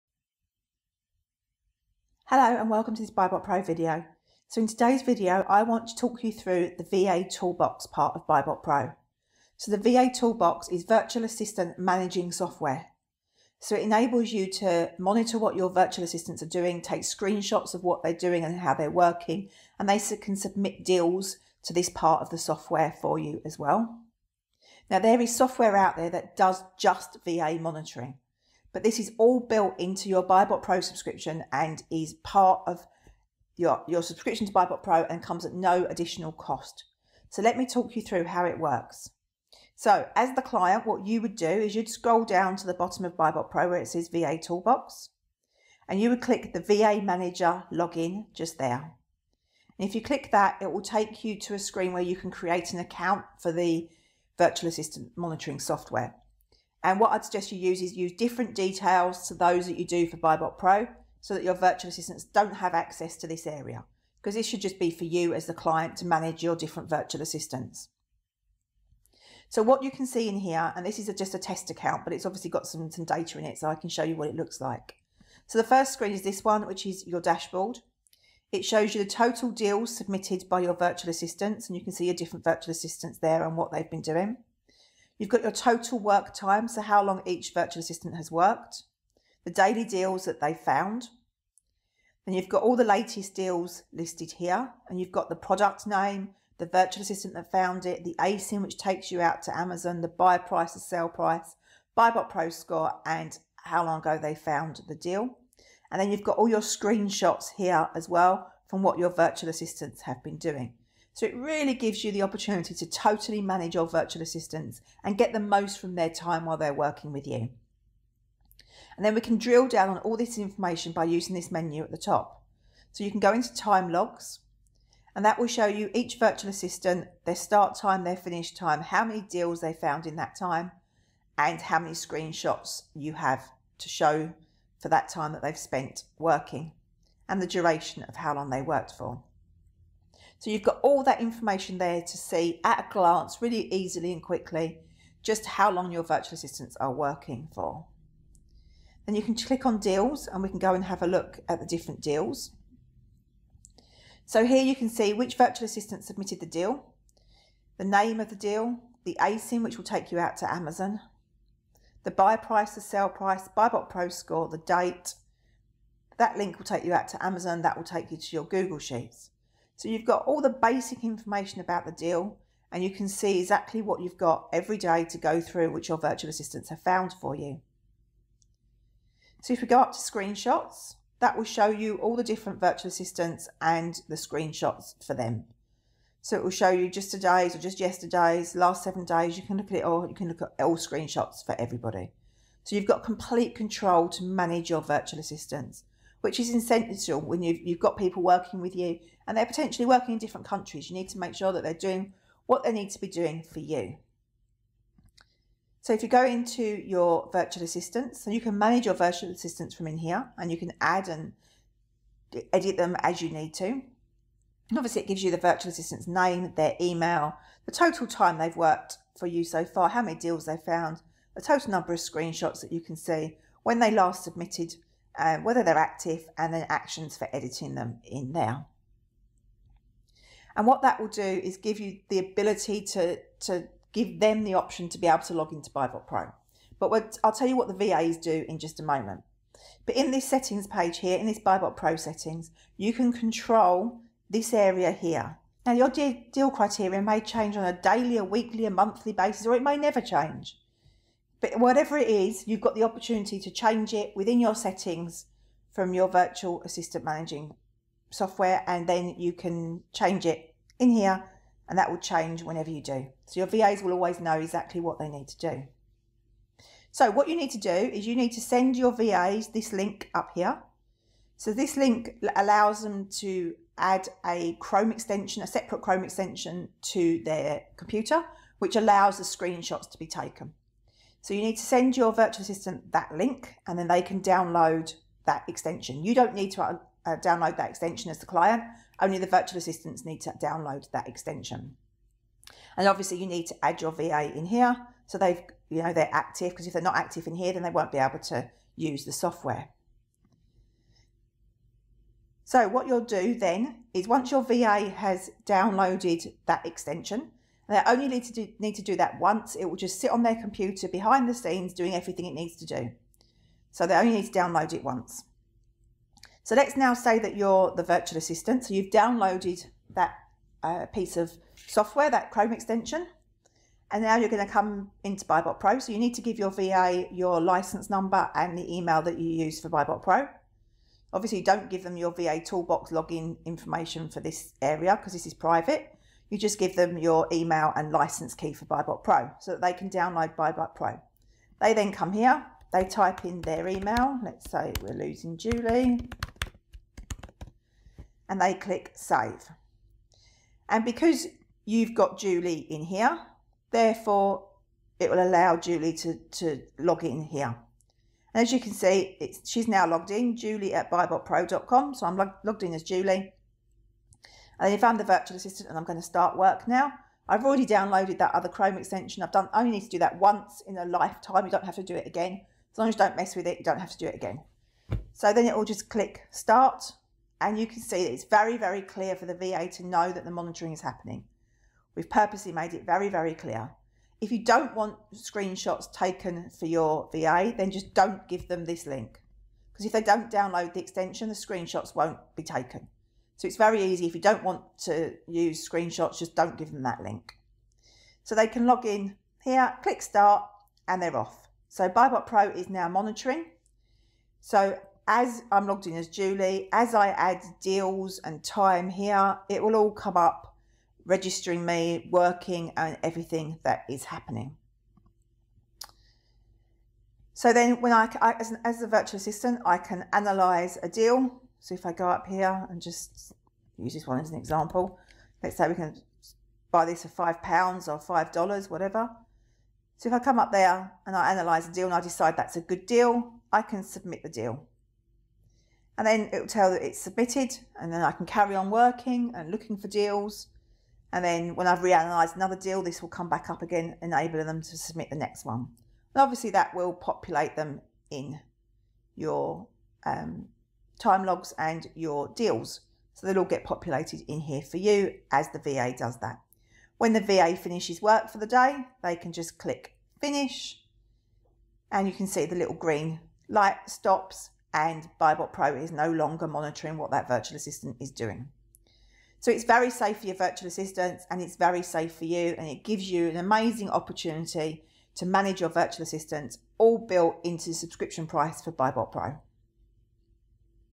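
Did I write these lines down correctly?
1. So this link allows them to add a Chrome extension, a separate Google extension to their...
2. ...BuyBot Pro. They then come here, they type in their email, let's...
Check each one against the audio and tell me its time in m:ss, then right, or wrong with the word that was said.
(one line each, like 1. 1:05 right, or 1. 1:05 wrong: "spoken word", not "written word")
1. 4:31 wrong: "Chrome", not "Google"
2. 5:40 right.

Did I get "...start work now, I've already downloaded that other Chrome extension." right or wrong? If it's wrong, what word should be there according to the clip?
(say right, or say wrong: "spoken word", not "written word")
right.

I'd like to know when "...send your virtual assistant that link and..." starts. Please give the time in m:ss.
4:41.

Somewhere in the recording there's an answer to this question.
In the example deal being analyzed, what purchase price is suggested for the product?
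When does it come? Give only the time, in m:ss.
7:07.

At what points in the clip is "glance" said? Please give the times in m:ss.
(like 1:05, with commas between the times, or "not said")
2:22.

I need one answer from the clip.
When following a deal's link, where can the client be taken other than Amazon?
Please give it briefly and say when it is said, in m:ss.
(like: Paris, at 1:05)
Google Sheets, at 2:48.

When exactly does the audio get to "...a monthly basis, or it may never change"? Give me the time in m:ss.
4:08.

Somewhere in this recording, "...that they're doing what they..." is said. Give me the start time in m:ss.
3:21.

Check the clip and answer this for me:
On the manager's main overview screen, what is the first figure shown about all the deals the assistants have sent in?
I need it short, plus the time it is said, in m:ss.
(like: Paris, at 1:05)
Total deals submitted, at 1:19.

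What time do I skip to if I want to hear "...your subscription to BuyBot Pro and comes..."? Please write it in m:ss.
0:33.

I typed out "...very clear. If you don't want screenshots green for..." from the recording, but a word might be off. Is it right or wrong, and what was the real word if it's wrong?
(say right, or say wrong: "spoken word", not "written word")
wrong: "taken", not "green".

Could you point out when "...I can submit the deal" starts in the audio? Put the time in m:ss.
7:13.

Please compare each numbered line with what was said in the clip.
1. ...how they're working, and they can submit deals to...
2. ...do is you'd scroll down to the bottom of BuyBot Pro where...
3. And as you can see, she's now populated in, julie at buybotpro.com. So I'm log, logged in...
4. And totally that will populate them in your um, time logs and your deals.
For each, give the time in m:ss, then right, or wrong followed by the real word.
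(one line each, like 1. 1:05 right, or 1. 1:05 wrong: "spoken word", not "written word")
1. 0:18 right
2. 0:41 right
3. 5:58 wrong: "logged", not "populated"
4. 7:26 wrong: "obviously", not "totally".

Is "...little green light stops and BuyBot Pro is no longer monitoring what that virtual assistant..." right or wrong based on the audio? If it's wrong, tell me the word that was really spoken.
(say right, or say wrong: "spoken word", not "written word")
right.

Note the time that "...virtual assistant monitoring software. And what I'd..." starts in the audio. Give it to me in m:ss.
0:54.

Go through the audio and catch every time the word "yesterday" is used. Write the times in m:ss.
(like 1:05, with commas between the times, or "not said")
3:07.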